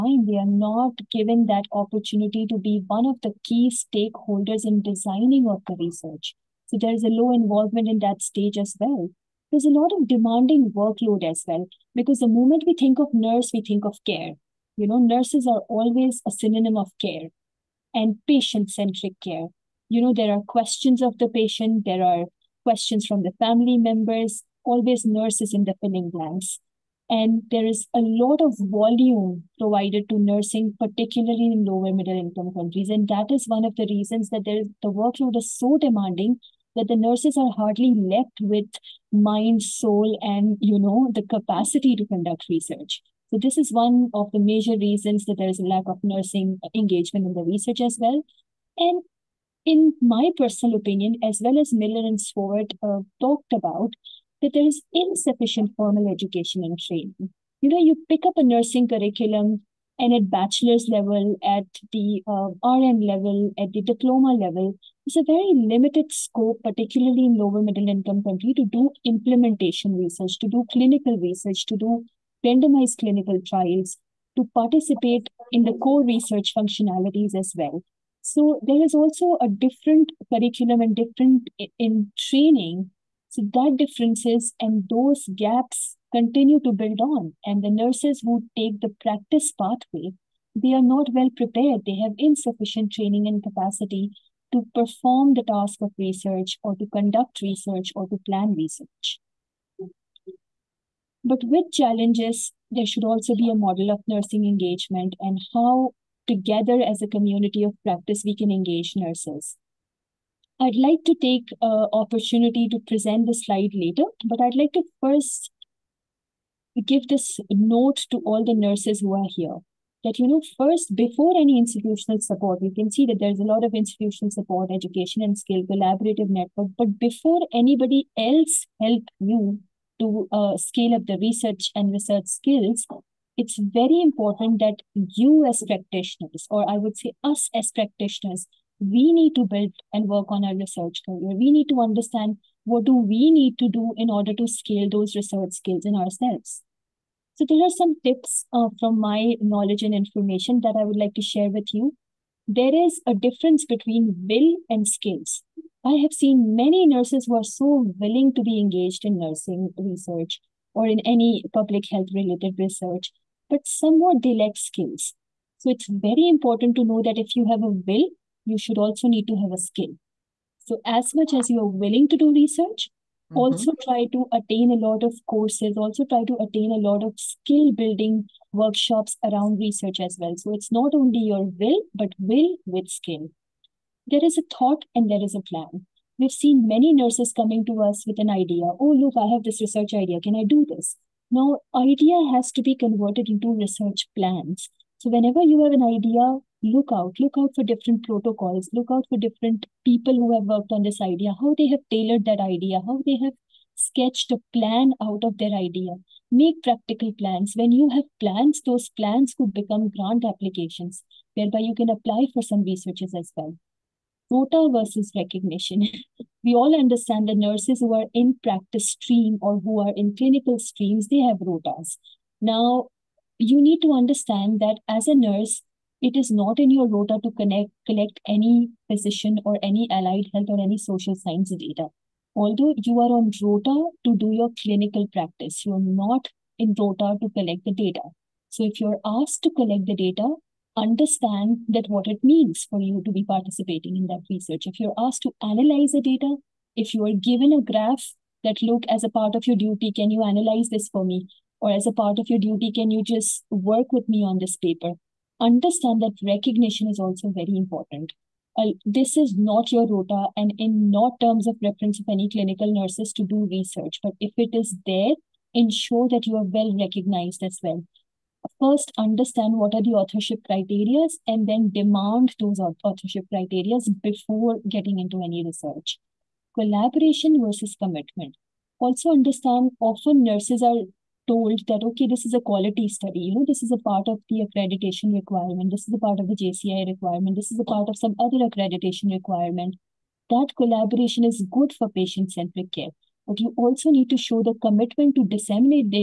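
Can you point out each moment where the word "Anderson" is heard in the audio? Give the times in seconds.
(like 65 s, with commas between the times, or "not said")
not said.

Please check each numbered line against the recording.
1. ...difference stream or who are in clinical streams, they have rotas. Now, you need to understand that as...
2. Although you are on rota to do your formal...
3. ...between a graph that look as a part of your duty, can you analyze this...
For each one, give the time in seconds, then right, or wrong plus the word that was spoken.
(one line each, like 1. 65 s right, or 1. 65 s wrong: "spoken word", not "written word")
1. 218 s wrong: "practice", not "difference"
2. 232 s wrong: "clinical", not "formal"
3. 247 s wrong: "given", not "between".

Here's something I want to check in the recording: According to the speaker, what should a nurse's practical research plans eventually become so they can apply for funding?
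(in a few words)
grant applications.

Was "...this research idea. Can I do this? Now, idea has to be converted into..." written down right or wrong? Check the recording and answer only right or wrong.
right.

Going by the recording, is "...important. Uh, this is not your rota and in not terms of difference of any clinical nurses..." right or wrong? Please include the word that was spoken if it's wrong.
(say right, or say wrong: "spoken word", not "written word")
wrong: "reference", not "difference".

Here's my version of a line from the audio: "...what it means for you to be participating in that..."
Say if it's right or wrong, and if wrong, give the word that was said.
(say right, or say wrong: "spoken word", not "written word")
right.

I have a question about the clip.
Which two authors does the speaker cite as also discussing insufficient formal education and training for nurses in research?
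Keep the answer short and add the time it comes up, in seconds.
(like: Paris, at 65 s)
Miller and Sword, at 51 s.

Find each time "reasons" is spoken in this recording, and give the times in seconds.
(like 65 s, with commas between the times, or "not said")
33 s, 44 s.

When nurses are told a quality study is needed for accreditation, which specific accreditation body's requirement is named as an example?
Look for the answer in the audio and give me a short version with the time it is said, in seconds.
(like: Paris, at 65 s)
JCI, at 286 s.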